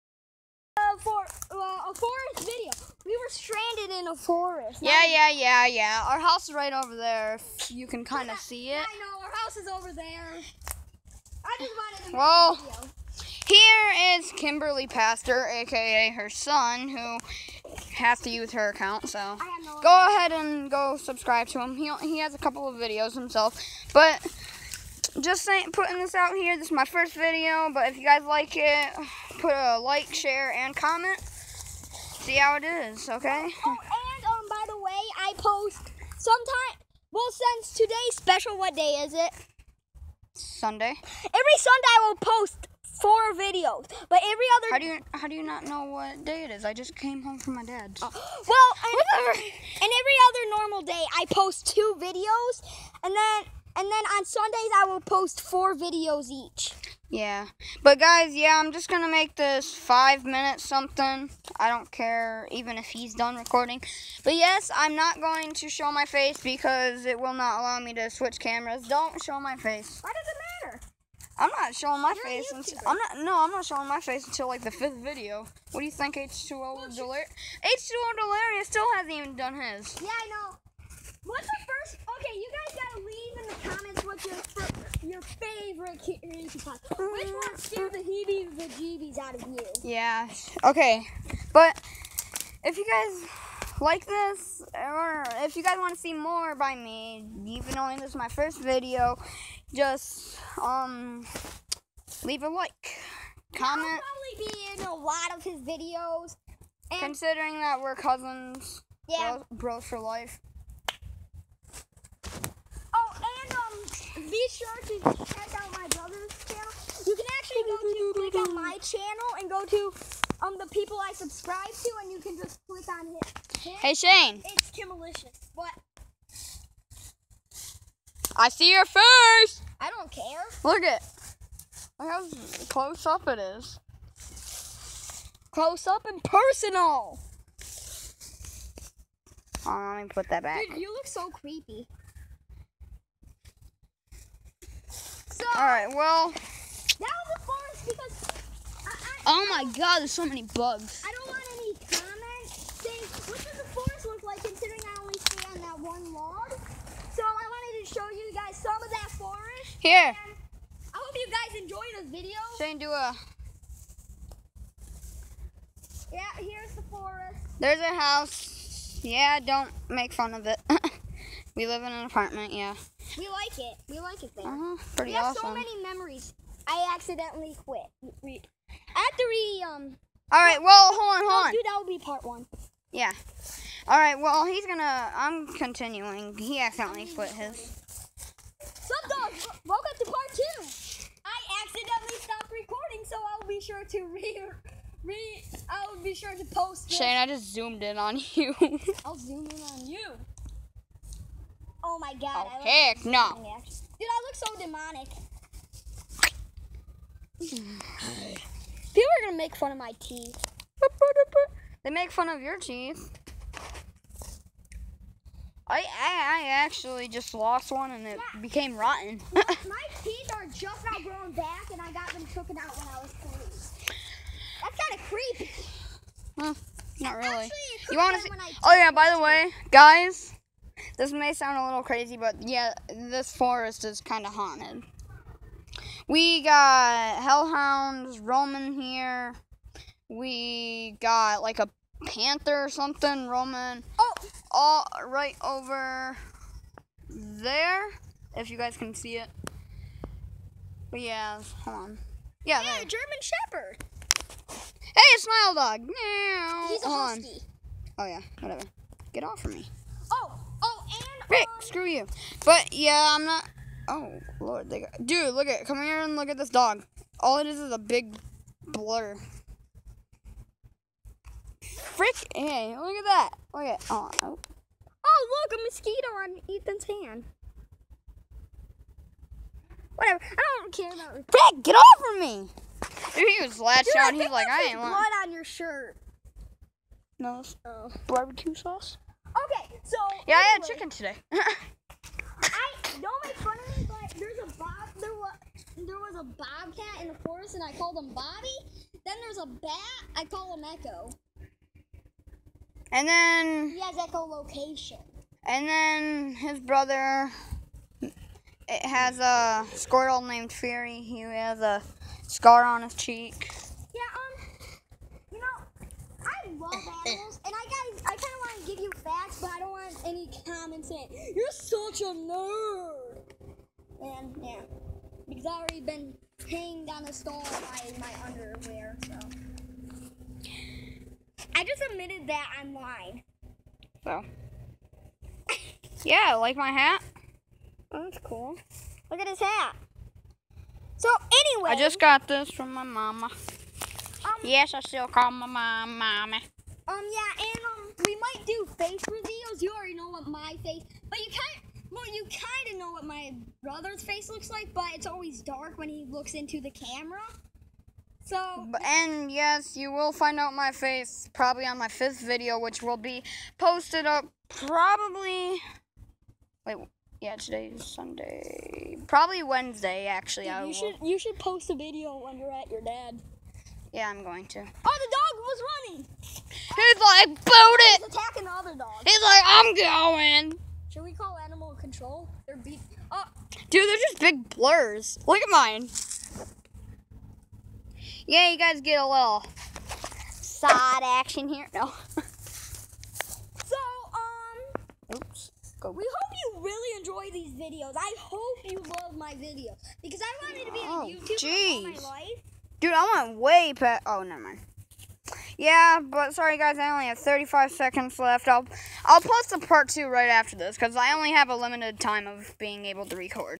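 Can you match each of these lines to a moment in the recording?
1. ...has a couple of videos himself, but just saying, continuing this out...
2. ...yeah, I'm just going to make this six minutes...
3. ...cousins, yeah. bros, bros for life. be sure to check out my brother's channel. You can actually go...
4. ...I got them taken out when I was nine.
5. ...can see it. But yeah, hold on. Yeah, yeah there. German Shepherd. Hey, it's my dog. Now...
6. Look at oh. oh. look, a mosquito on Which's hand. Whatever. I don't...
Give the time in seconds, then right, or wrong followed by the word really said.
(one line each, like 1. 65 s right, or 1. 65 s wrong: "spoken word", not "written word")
1. 22 s wrong: "putting", not "continuing"
2. 58 s wrong: "five", not "six"
3. 107 s right
4. 221 s wrong: "three", not "nine"
5. 248 s right
6. 273 s wrong: "Ethan", not "Which".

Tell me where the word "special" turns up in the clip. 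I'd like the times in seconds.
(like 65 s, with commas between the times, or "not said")
38 s.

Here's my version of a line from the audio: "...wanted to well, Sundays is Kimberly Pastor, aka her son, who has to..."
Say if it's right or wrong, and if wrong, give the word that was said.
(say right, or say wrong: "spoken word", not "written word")
wrong: "Here", not "Sundays".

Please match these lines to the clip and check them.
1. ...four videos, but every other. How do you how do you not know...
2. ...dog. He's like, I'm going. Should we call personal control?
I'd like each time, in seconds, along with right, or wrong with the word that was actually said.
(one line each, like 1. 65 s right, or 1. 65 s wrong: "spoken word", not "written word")
1. 43 s right
2. 378 s wrong: "animal", not "personal".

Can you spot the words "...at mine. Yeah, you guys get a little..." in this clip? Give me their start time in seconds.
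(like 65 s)
385 s.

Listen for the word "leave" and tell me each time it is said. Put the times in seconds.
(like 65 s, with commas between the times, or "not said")
83 s, 102 s.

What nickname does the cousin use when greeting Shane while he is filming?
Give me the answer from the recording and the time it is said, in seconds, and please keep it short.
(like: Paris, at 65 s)
Kimmalicious, at 124 s.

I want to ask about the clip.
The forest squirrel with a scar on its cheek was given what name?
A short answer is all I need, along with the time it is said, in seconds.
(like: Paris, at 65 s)
Fury, at 310 s.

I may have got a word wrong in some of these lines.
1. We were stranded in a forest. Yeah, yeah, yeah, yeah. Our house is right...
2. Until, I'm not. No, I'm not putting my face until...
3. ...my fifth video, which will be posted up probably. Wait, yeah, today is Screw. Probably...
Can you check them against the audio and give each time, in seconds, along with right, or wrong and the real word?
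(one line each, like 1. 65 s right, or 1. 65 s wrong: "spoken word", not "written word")
1. 3 s right
2. 72 s wrong: "showing", not "putting"
3. 361 s wrong: "Sunday", not "Screw".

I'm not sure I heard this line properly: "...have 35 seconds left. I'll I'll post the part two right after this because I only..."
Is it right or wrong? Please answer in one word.
right.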